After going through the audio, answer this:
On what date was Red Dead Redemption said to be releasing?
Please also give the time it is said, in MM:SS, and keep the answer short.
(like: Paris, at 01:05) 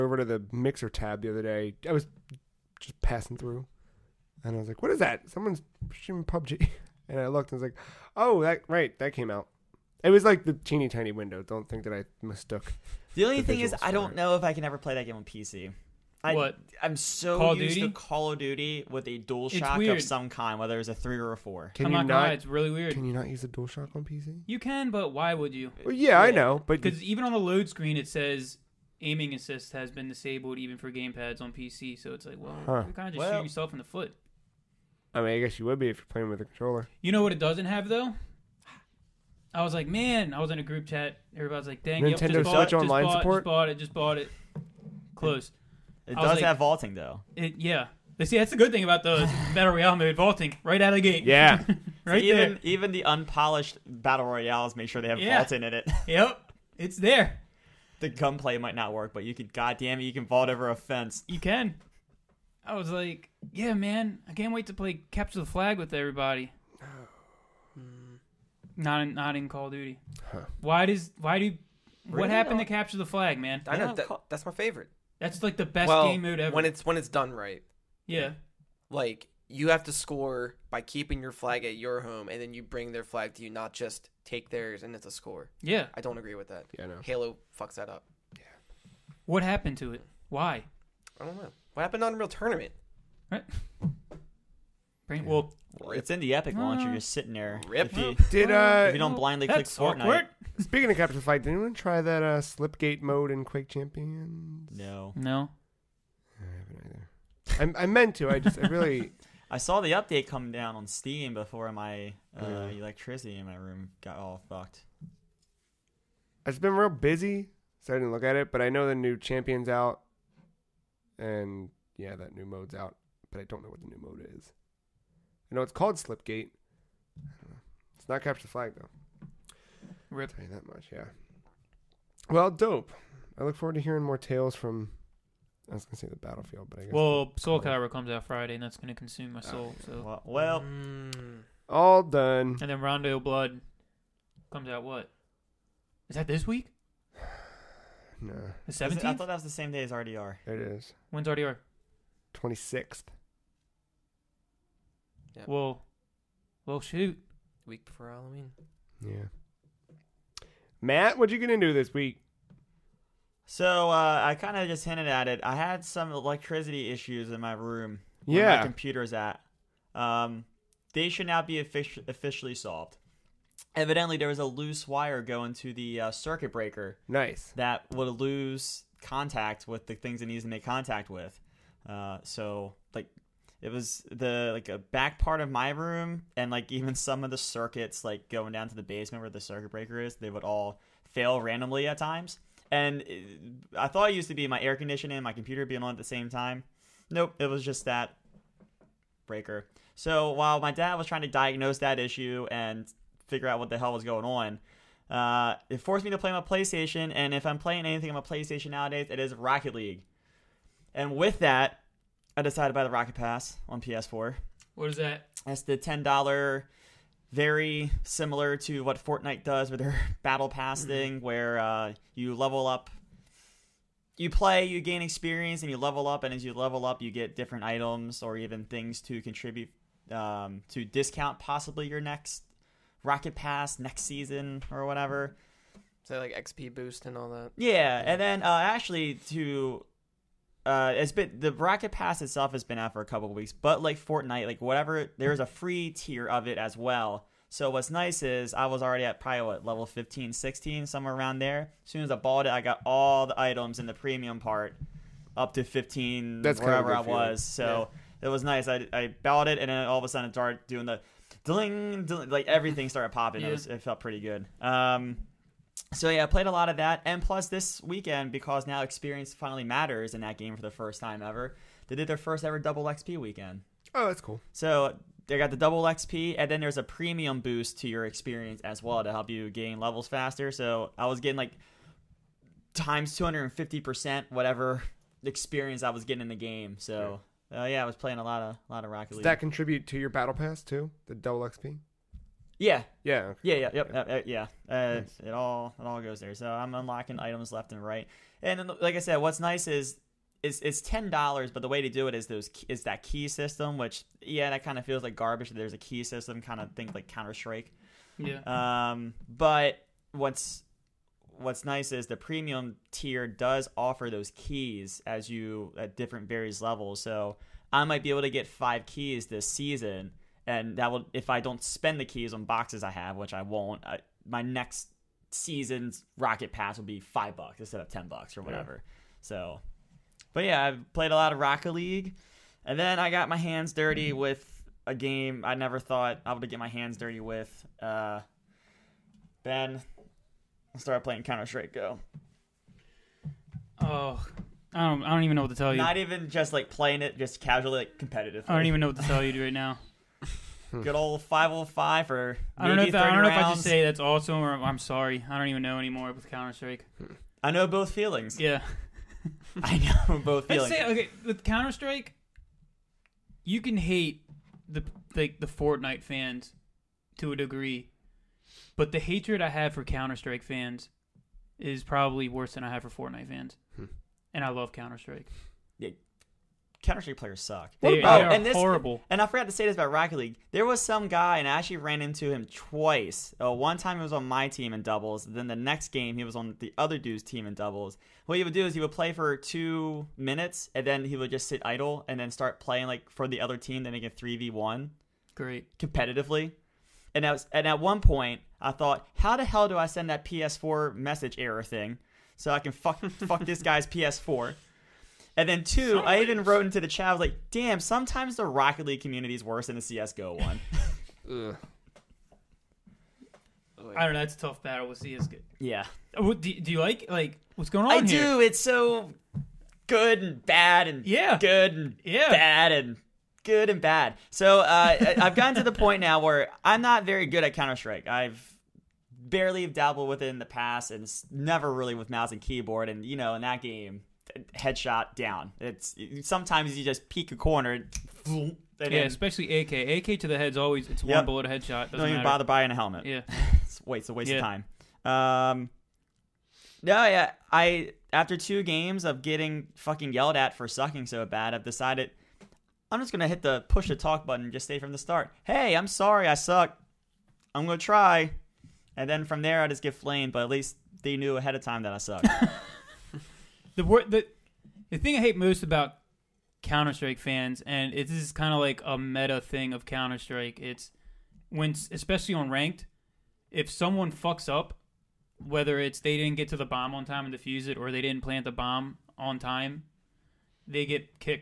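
26th, at 02:32.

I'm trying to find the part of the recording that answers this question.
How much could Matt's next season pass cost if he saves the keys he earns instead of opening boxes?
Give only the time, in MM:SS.
05:27.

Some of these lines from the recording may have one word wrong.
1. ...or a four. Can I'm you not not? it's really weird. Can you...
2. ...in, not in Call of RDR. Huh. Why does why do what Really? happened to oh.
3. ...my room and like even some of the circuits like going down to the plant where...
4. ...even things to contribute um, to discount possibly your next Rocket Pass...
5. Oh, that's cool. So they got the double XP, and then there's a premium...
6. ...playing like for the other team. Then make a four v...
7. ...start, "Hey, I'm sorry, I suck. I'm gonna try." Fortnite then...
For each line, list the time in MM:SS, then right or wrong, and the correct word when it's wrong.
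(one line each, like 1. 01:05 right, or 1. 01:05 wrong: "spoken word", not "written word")
1. 00:21 right
2. 01:09 wrong: "Duty", not "RDR"
3. 03:05 wrong: "basement", not "plant"
4. 03:48 right
5. 04:33 right
6. 06:32 wrong: "three", not "four"
7. 07:34 wrong: "And", not "Fortnite".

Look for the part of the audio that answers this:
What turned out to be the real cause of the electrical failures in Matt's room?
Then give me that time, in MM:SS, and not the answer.
02:54.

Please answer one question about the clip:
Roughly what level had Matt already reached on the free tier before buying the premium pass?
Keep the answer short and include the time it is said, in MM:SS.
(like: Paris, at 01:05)
Level 15, at 04:09.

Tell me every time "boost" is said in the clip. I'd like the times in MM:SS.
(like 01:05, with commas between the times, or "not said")
03:56, 04:37.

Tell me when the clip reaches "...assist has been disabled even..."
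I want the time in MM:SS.
00:29.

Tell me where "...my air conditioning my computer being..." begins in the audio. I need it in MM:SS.
03:14.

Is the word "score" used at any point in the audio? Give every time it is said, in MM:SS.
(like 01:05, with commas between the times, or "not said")
01:19, 01:25.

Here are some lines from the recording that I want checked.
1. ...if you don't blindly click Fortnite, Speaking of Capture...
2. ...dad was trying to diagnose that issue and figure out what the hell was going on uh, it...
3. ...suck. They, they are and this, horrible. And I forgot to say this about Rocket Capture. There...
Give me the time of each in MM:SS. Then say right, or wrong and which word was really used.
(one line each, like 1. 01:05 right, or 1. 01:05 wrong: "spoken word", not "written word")
1. 01:38 right
2. 03:20 right
3. 06:17 wrong: "League", not "Capture".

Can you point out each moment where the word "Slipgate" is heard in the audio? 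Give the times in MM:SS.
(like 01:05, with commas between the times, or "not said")
01:42, 02:05.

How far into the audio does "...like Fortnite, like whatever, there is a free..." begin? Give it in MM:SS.
04:03.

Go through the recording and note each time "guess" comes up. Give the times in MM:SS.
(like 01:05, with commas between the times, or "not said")
00:35, 02:16.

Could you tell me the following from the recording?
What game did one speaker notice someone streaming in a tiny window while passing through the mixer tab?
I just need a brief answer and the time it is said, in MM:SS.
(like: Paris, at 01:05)
PUBG, at 00:06.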